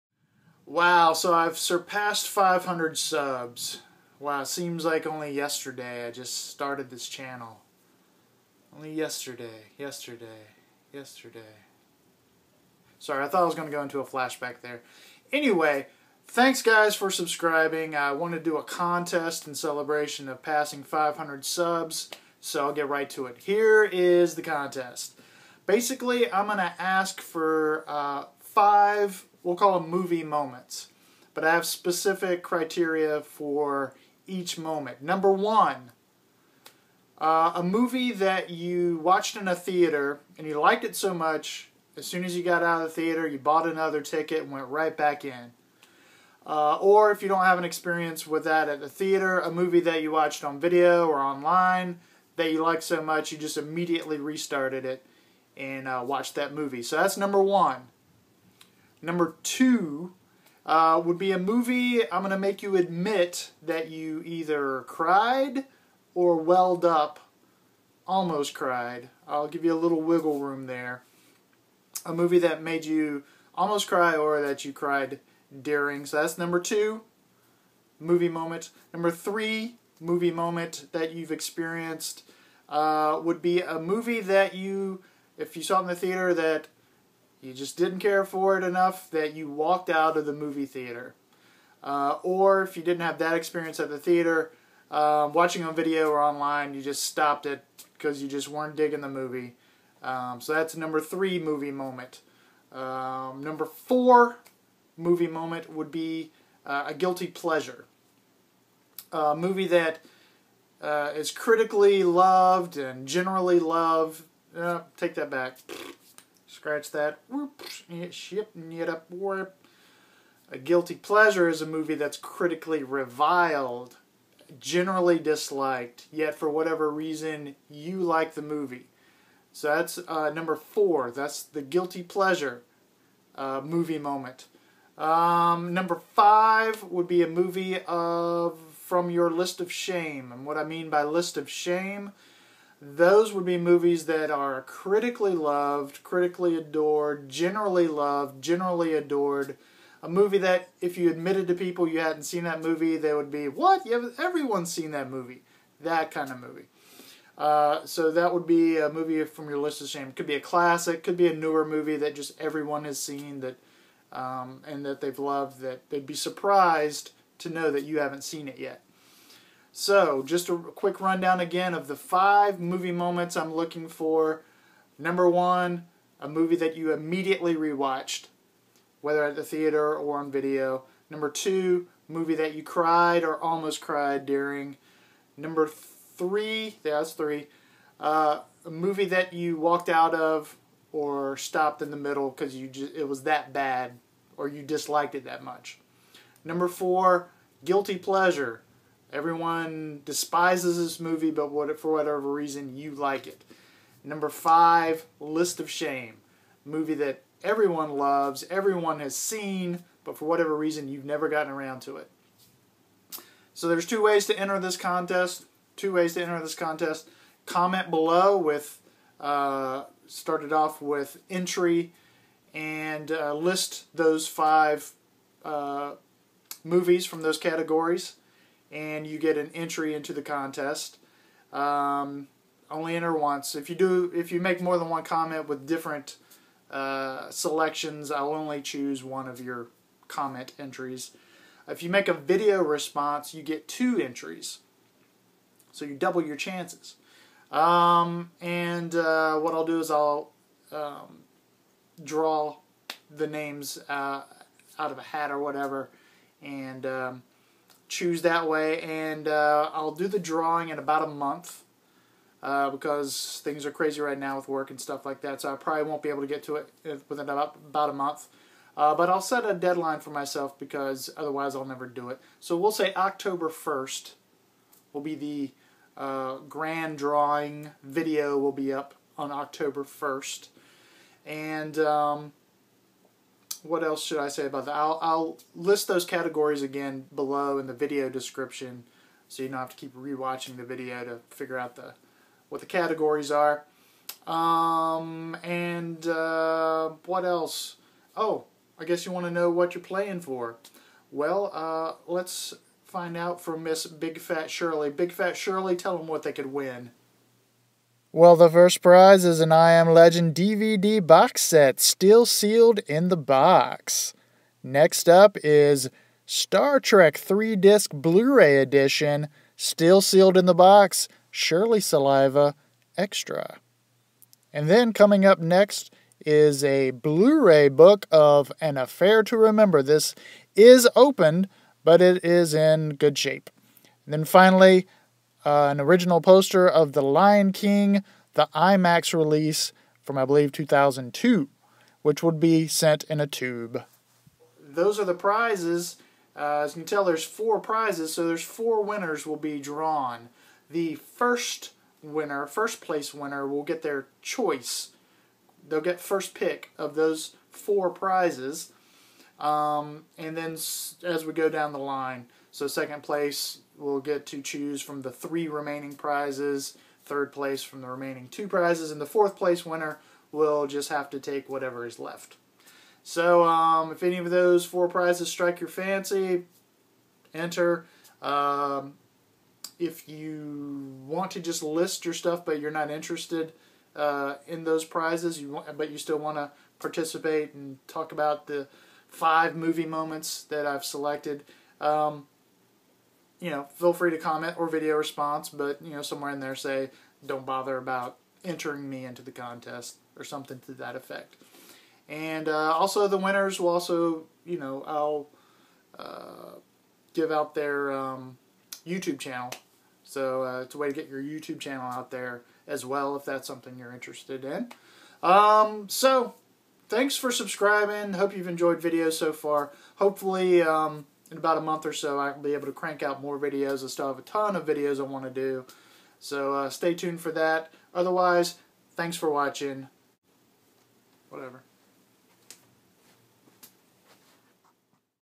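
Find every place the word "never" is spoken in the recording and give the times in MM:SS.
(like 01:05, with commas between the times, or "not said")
03:31, 04:31.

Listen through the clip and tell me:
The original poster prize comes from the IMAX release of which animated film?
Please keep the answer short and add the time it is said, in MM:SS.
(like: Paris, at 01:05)
The Lion King, at 05:36.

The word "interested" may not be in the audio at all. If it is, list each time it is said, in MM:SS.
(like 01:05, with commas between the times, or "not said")
06:22, 06:53.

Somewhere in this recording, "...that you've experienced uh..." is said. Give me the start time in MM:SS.
01:20.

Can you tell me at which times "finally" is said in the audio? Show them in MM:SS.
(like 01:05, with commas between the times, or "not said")
05:34.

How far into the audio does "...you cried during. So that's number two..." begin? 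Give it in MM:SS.
01:14.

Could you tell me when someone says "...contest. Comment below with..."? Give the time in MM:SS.
03:36.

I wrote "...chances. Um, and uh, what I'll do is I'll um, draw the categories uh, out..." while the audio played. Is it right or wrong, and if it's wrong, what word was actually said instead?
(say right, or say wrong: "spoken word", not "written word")
wrong: "names", not "categories".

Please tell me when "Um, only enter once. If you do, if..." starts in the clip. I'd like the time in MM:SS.
03:51.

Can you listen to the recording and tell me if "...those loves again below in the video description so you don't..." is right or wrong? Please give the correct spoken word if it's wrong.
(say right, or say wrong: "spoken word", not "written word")
wrong: "categories", not "loves".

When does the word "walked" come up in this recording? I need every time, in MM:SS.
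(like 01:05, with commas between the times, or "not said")
01:29, 03:09.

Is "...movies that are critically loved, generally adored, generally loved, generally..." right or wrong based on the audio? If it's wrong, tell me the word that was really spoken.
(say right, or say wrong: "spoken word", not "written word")
wrong: "critically", not "generally".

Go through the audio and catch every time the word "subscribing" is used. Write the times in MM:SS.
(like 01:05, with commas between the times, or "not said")
00:17, 06:57.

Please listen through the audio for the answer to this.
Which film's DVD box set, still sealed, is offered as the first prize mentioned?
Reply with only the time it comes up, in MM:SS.
05:09.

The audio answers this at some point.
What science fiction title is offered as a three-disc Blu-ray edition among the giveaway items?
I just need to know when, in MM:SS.
05:16.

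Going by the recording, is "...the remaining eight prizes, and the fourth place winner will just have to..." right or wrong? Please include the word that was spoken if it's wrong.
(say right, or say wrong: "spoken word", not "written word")
wrong: "two", not "eight".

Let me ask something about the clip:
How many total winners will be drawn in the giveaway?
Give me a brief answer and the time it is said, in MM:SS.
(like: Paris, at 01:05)
4, at 05:48.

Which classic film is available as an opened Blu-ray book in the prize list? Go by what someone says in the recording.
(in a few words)
An Affair to Remember.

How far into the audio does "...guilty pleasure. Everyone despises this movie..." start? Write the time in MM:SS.
03:17.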